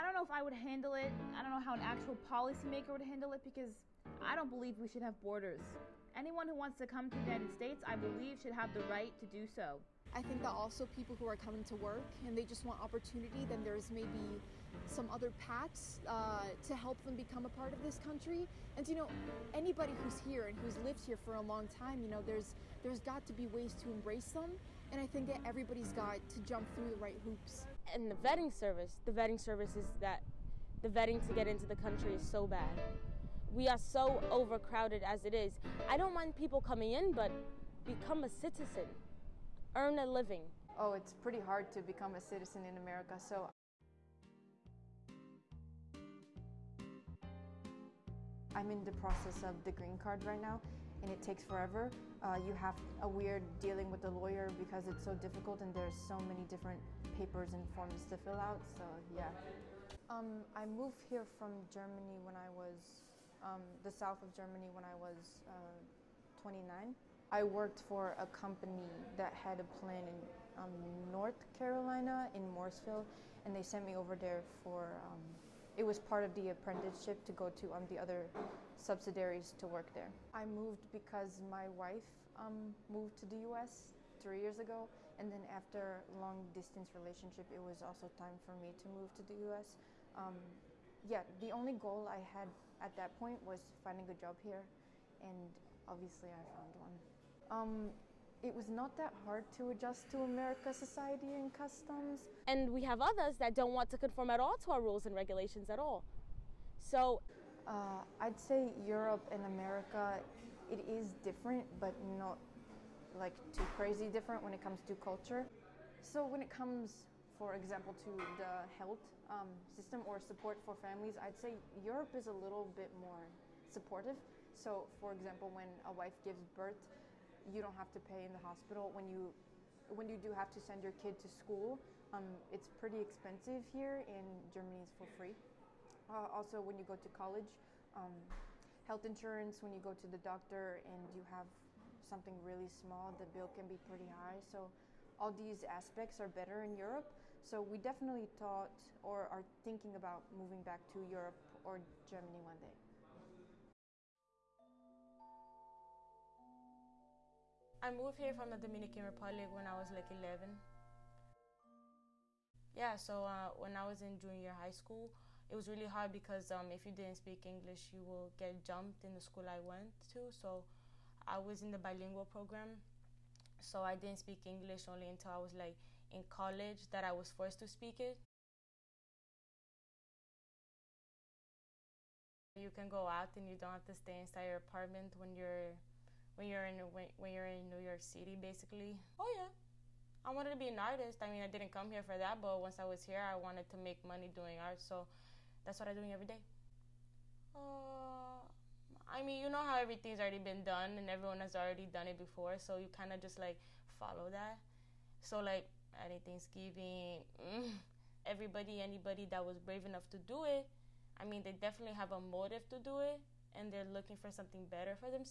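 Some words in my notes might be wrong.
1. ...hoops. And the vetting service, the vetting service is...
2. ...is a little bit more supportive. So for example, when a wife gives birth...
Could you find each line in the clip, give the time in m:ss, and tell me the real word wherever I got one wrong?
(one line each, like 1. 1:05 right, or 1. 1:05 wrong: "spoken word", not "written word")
1. 0:27 right
2. 2:02 right.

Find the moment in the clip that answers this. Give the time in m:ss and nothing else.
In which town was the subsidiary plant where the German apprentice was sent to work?
1:12.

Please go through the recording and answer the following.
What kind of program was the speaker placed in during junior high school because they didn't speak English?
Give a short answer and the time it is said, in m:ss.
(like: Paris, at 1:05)
bilingual program, at 2:51.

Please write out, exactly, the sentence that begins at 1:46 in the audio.
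So uh, I'd say Europe and America, it is different, but not like too crazy different when it comes to culture.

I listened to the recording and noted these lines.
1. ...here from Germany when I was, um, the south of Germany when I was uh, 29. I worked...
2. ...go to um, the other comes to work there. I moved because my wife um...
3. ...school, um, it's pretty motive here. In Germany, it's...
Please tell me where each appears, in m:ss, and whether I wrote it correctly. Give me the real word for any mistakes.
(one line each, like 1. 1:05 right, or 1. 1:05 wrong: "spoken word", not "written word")
1. 1:01 right
2. 1:17 wrong: "subsidiaries", not "comes"
3. 2:11 wrong: "expensive", not "motive".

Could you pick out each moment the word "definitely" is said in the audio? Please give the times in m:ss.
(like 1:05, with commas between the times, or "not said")
2:27, 3:31.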